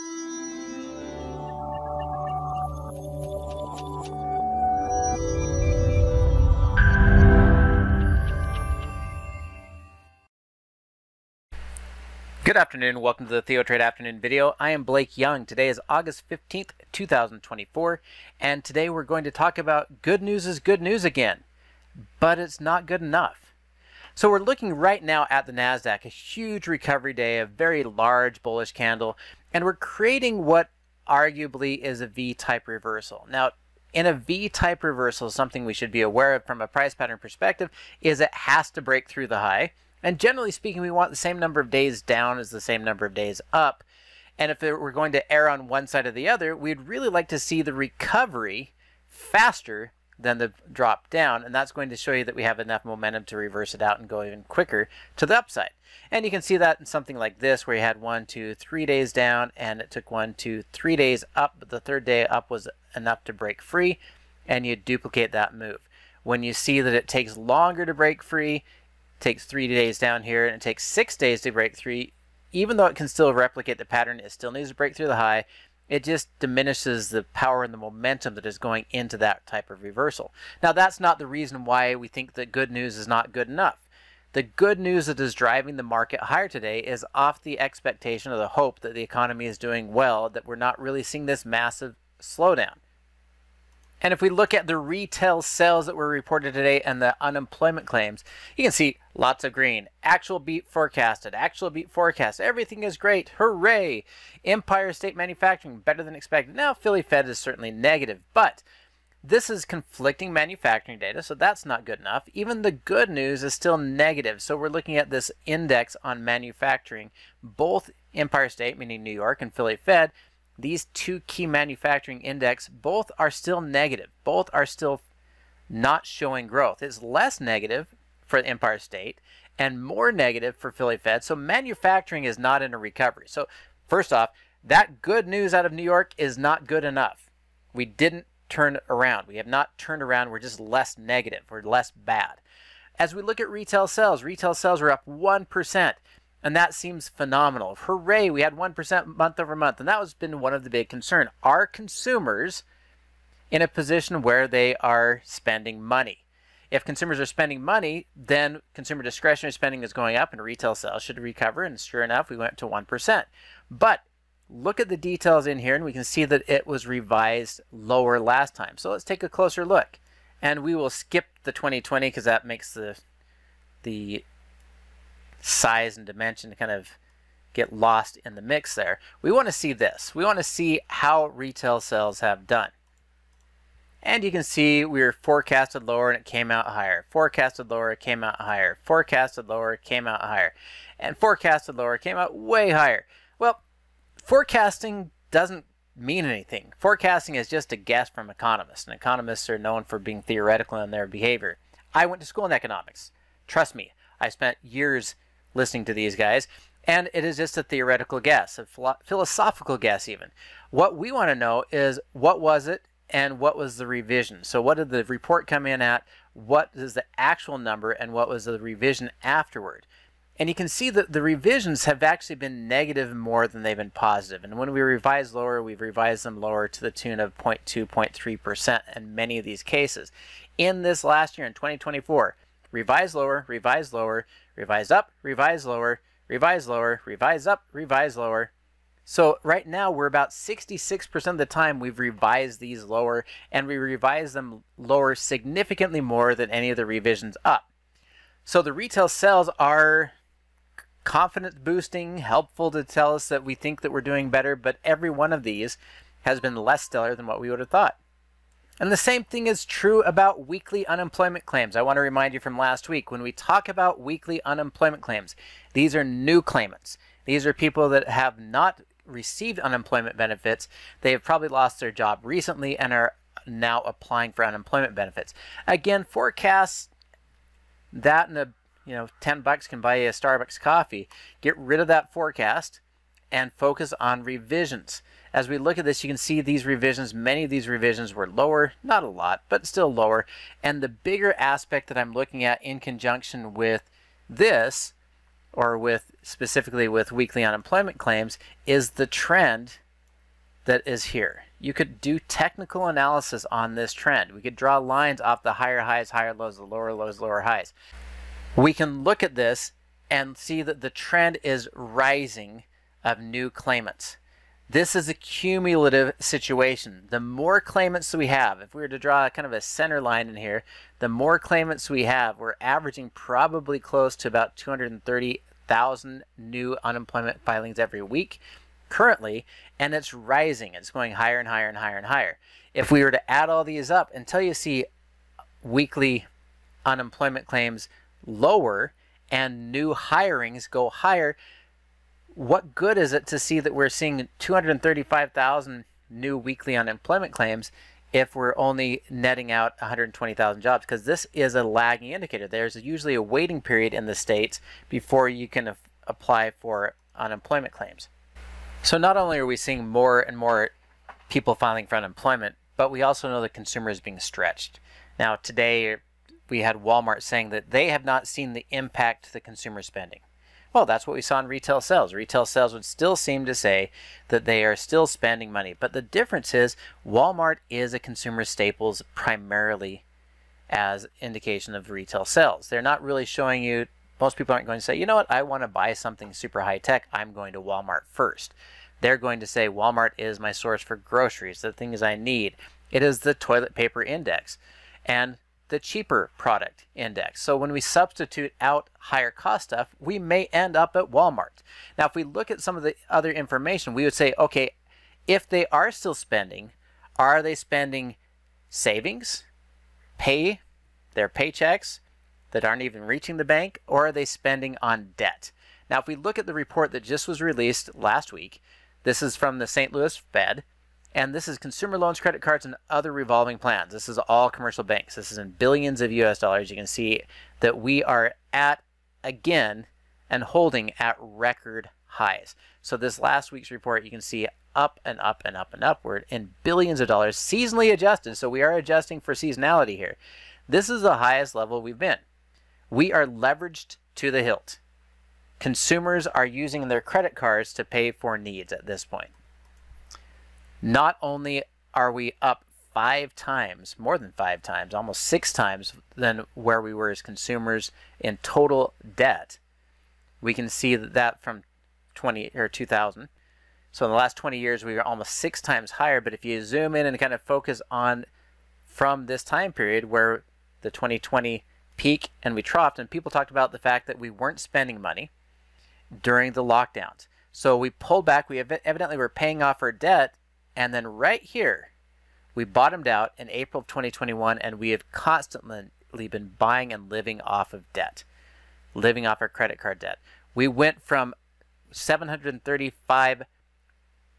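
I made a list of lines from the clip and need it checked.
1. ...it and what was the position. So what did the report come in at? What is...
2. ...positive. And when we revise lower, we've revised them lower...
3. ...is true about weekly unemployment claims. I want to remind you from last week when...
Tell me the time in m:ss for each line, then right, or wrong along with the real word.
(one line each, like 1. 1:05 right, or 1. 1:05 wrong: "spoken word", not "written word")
1. 3:32 wrong: "revision", not "position"
2. 3:43 right
3. 4:19 right.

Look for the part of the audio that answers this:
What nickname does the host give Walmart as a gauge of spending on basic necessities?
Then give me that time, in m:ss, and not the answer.
6:33.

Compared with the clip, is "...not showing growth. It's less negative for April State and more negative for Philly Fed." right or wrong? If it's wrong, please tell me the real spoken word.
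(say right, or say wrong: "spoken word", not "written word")
wrong: "Empire", not "April".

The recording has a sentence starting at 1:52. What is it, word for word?
Even the good news is still negative, so we're looking at this index on manufacturing.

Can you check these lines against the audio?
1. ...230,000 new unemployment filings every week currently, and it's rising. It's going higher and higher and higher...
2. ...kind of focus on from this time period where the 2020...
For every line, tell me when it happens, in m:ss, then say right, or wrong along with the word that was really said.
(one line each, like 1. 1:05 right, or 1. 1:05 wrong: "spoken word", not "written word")
1. 5:24 right
2. 7:47 right.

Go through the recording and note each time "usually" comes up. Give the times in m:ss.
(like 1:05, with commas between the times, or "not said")
5:52.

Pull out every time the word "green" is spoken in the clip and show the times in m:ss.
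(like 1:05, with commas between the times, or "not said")
1:39.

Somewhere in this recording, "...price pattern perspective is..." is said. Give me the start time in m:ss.
0:36.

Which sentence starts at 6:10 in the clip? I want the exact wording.
Well, that's what we saw in retail sales.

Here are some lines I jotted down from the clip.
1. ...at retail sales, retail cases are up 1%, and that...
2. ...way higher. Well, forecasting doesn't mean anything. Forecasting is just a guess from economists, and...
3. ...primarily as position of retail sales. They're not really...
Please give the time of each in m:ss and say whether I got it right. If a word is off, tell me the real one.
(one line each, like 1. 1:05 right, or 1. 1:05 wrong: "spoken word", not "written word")
1. 2:23 wrong: "sales", not "cases"
2. 3:12 right
3. 6:19 wrong: "indication", not "position".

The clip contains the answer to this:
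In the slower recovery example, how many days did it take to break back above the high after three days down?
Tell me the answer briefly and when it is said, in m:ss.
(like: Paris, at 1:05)
6, at 1:10.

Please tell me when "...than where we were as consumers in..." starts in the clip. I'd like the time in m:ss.
7:36.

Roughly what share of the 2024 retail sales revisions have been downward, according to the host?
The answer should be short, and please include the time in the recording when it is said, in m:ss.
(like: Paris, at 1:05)
66%, at 4:00.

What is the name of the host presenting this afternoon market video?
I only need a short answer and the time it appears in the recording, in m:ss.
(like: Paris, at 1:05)
Blake Young, at 0:14.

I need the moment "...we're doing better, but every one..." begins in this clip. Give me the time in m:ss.
4:13.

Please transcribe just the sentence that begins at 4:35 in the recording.
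Again, forecasts that and a you know 10 bucks can buy you a Starbucks coffee.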